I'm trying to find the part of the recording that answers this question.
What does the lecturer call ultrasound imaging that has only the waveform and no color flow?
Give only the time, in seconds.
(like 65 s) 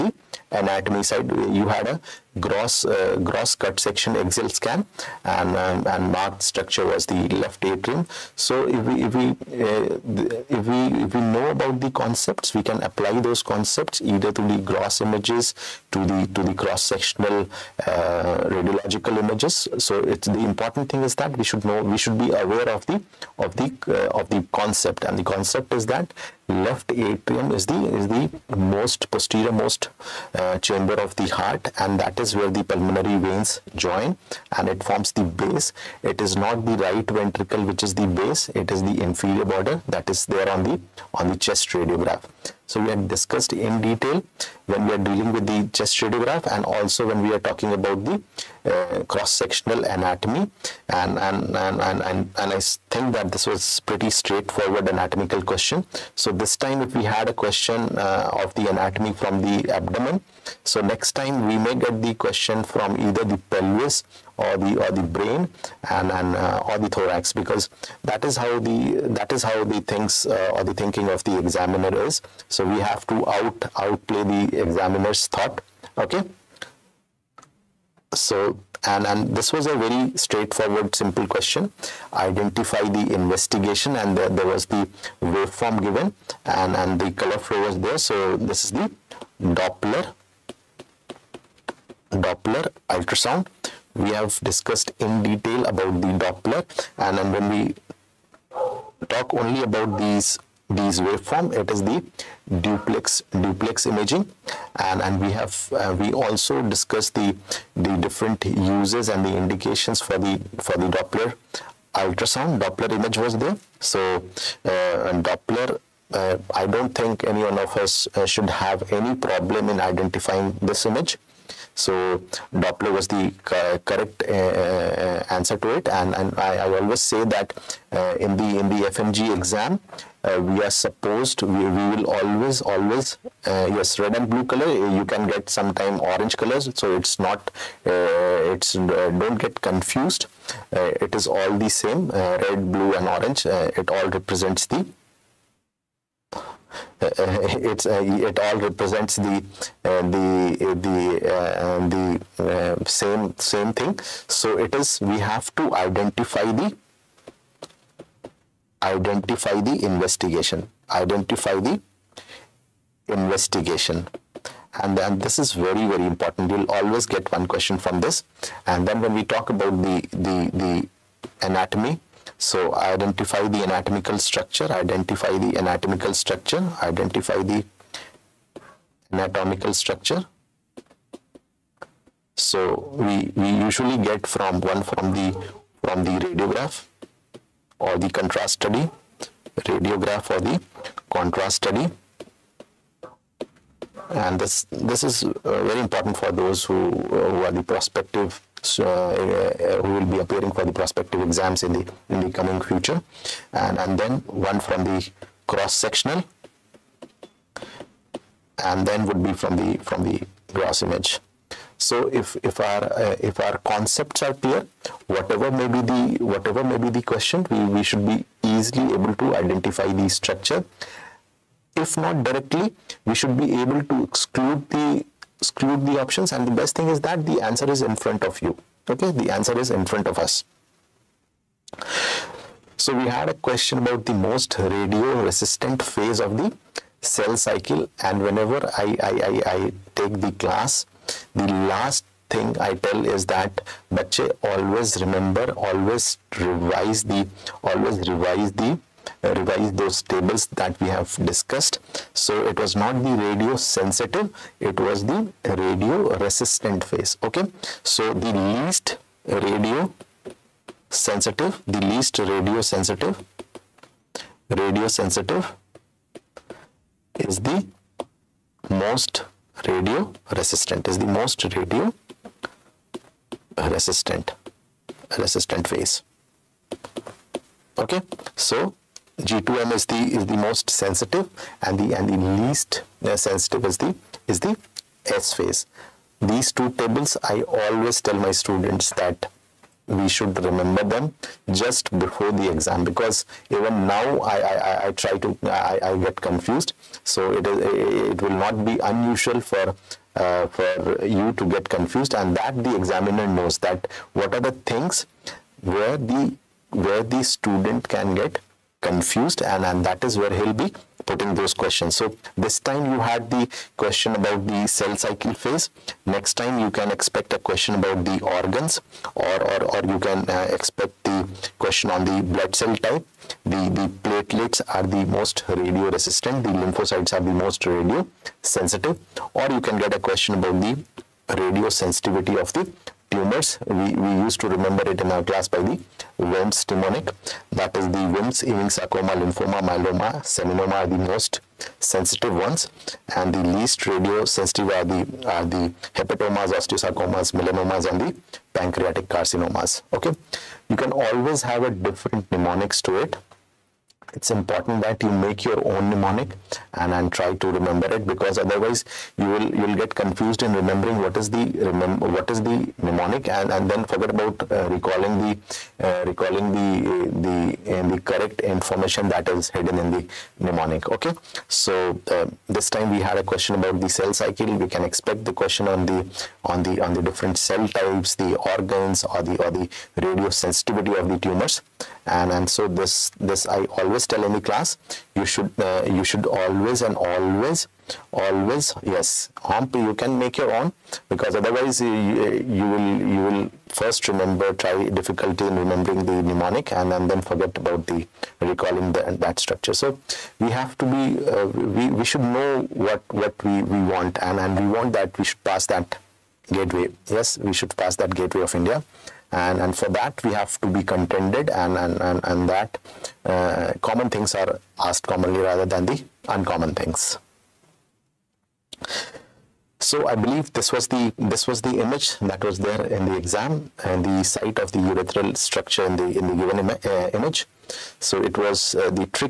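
102 s.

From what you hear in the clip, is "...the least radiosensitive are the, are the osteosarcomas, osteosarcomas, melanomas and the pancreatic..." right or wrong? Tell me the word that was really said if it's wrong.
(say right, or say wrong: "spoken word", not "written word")
wrong: "hepatomas", not "osteosarcomas".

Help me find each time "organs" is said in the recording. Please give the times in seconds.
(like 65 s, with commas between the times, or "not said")
318 s, 378 s.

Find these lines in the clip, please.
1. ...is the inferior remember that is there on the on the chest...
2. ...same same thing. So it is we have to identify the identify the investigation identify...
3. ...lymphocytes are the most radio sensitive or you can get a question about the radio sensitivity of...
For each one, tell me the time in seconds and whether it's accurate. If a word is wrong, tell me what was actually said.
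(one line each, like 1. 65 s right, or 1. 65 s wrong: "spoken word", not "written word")
1. 38 s wrong: "border", not "remember"
2. 152 s right
3. 326 s right.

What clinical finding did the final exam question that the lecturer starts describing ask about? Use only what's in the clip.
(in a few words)
Urethral stricture.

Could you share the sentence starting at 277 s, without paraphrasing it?
Okay, so G2M is the is the most sensitive and the and the least uh, sensitive is the is the S phase.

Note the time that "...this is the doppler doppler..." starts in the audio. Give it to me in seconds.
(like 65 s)
88 s.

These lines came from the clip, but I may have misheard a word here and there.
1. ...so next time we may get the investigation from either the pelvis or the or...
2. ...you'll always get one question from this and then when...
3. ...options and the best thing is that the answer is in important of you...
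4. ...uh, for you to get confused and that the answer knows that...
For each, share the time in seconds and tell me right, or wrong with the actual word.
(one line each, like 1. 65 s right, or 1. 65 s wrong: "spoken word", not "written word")
1. 60 s wrong: "question", not "investigation"
2. 166 s right
3. 226 s wrong: "front", not "important"
4. 300 s wrong: "examiner", not "answer".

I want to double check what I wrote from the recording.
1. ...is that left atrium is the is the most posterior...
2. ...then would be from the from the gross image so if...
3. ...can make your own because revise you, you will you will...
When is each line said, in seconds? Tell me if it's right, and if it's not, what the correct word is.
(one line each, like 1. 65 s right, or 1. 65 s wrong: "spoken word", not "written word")
1. 25 s right
2. 208 s right
3. 389 s wrong: "otherwise", not "revise".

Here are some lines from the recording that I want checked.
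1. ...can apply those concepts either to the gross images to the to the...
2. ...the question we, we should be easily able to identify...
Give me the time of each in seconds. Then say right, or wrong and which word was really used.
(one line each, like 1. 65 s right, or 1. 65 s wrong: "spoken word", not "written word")
1. 12 s right
2. 216 s right.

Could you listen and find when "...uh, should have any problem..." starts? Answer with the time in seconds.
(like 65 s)
118 s.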